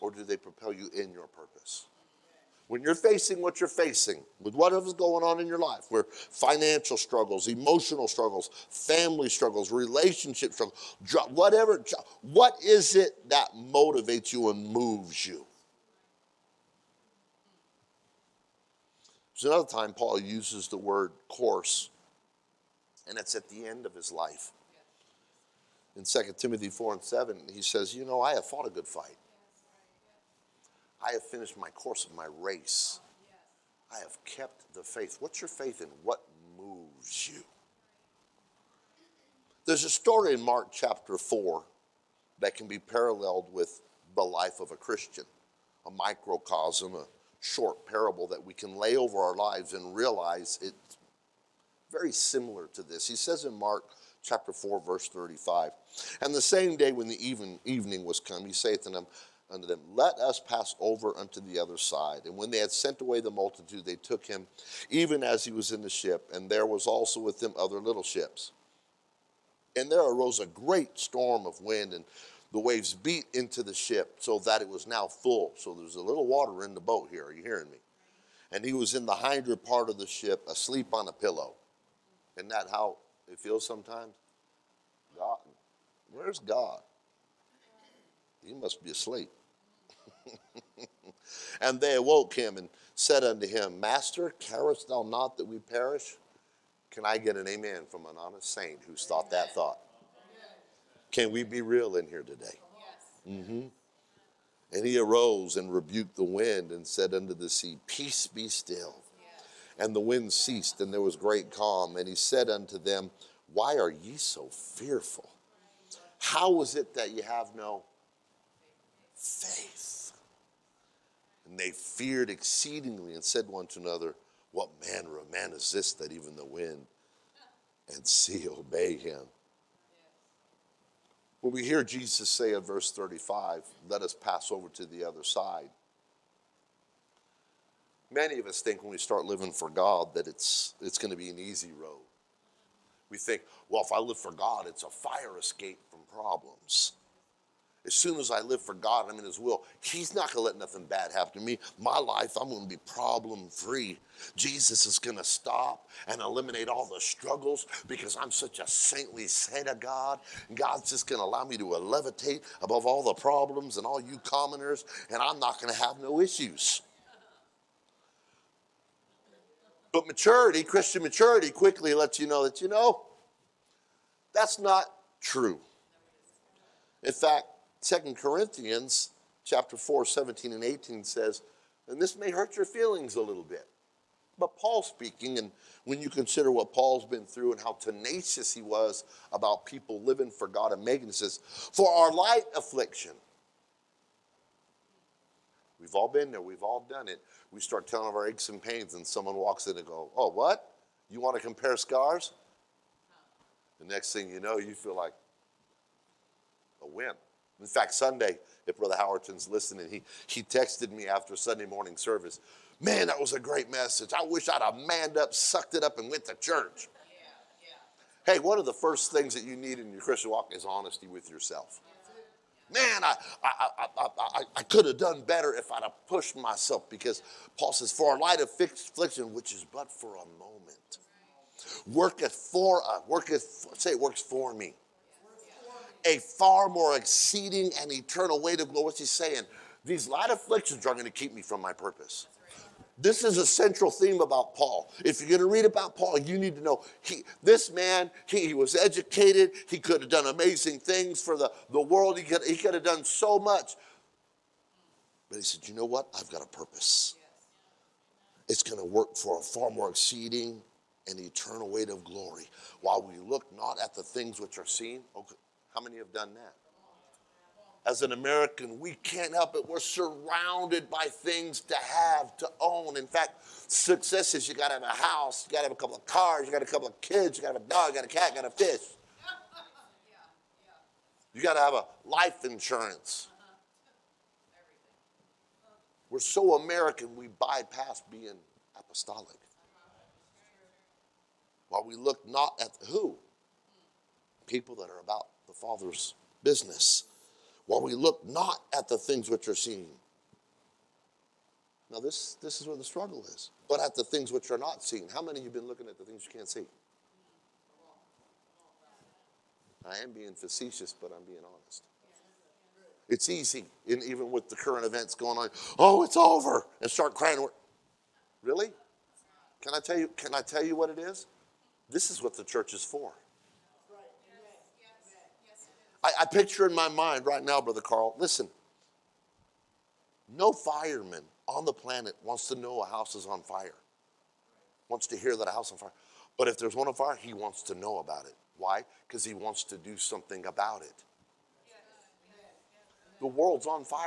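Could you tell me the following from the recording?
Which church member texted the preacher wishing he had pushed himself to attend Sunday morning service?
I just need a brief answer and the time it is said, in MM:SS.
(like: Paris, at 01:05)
Brother Howerton, at 03:28.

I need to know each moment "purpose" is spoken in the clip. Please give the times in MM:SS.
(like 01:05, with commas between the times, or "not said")
00:01, 04:01, 04:16.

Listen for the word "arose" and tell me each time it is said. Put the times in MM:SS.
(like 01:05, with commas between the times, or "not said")
01:10, 01:44.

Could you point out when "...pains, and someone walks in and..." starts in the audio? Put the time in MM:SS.
03:18.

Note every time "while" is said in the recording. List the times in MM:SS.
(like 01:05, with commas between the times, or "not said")
04:22, 04:51, 04:57.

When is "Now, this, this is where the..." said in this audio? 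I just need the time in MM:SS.
05:01.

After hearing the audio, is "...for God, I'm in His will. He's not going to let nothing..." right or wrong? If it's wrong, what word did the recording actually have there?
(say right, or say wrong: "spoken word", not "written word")
right.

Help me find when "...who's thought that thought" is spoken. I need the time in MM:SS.
01:38.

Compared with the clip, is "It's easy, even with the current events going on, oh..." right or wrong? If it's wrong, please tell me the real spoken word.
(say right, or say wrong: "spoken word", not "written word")
right.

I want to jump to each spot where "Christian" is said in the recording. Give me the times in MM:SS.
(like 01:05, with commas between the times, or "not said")
00:44, 02:50, 03:40.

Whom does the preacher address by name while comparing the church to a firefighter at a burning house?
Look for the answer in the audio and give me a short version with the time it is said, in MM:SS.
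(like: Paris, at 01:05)
Brother Carl, at 05:27.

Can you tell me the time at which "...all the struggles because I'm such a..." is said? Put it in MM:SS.
02:36.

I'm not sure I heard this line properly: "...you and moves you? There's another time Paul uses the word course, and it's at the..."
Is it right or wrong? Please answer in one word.
right.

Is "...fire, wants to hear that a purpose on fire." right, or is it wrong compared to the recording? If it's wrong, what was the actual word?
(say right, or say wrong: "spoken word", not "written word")
wrong: "house", not "purpose".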